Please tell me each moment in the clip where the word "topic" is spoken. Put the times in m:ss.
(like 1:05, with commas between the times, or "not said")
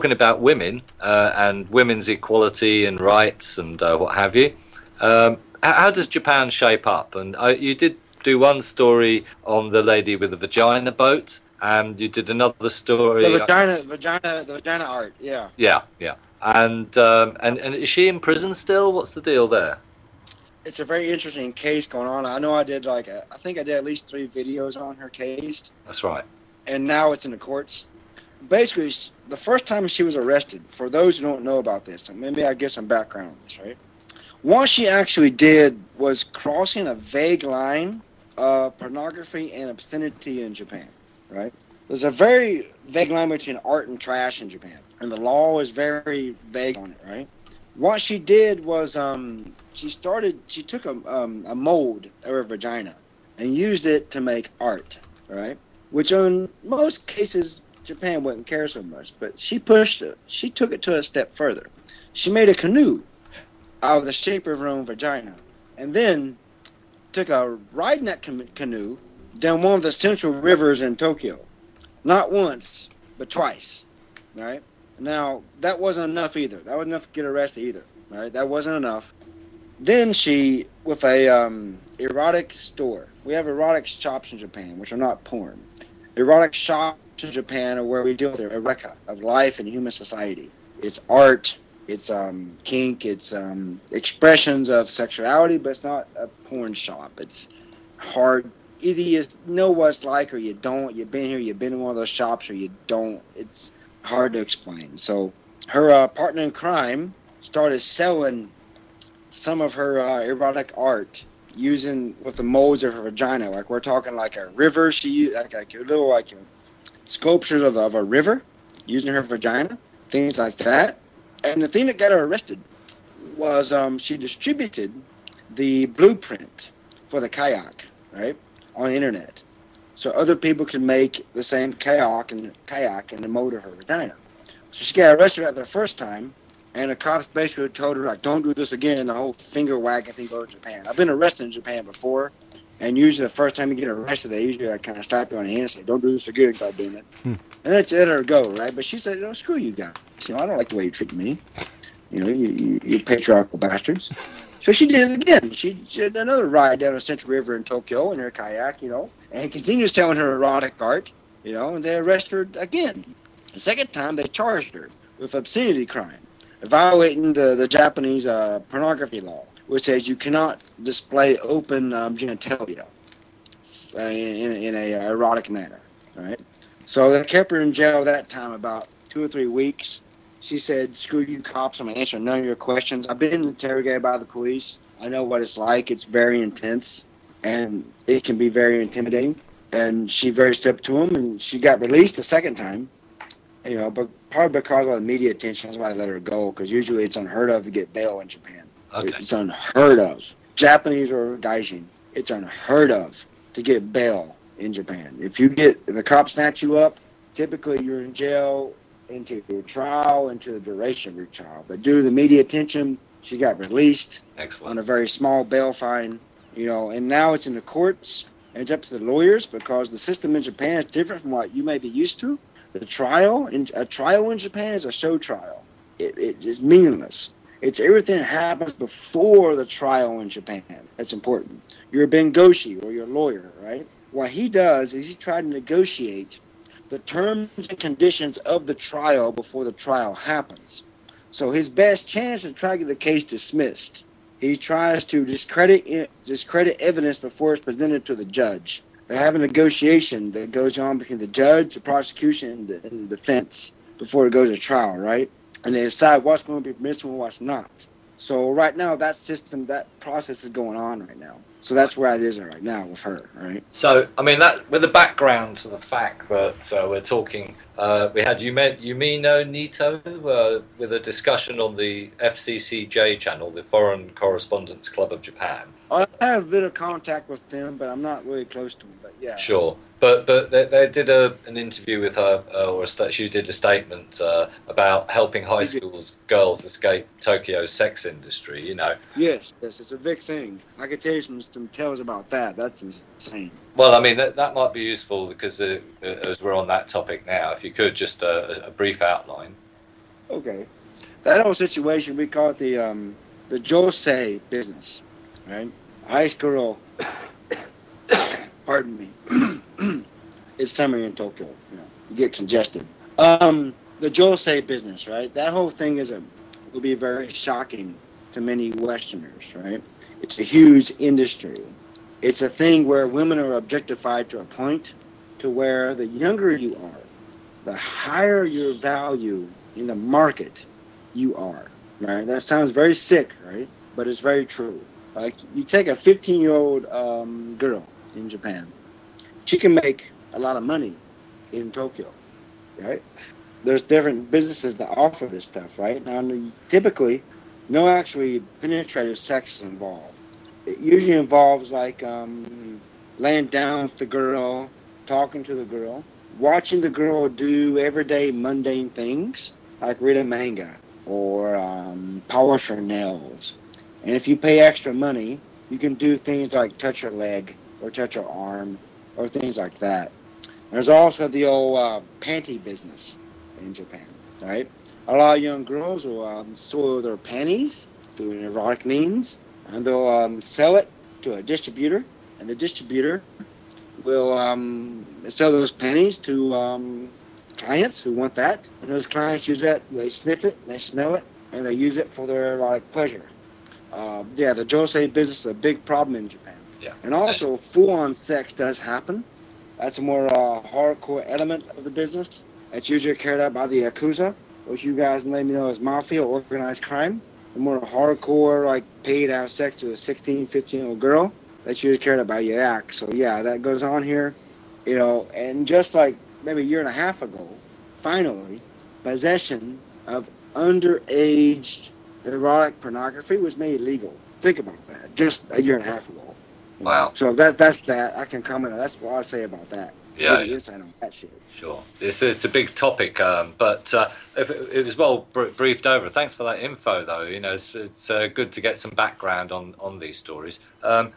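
4:56, 7:12.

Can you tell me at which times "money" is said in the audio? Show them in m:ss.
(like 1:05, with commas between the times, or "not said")
5:40, 6:04.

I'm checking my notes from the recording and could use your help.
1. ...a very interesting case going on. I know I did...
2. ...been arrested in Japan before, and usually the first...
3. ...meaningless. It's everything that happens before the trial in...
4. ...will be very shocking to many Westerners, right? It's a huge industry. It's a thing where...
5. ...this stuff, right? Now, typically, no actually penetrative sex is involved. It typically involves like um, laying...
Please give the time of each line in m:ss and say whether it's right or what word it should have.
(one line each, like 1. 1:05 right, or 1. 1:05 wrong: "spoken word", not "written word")
1. 0:20 right
2. 2:20 right
3. 3:46 right
4. 5:16 right
5. 5:45 wrong: "usually", not "typically".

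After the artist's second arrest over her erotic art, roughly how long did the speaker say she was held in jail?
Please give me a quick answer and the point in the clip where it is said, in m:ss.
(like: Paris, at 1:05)
two or three weeks, at 2:59.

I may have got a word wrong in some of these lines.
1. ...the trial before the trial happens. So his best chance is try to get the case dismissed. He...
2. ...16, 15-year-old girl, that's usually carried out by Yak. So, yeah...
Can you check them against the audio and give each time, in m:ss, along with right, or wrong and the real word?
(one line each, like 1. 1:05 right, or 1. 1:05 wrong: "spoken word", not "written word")
1. 3:58 right
2. 6:49 right.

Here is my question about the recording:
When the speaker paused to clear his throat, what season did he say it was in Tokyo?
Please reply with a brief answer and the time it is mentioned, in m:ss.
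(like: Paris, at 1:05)
summer, at 5:10.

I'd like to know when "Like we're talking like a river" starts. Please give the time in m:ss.
1:53.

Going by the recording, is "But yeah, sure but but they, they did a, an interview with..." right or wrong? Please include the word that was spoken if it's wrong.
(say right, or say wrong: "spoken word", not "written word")
right.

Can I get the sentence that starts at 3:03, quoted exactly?
I've been interrogated by the police.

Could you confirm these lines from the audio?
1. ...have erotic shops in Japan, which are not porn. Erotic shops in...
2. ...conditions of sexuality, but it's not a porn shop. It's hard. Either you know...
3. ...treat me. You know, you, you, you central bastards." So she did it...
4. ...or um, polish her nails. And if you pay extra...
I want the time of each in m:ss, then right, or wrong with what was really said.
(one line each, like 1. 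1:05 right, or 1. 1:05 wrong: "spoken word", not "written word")
1. 1:23 right
2. 1:33 wrong: "expressions", not "conditions"
3. 2:30 wrong: "patriarchal", not "central"
4. 6:01 right.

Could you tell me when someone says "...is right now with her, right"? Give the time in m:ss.
4:22.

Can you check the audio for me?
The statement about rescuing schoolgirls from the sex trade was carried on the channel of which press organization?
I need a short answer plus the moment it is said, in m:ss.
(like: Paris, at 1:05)
Foreign Correspondents Club of Japan, at 4:33.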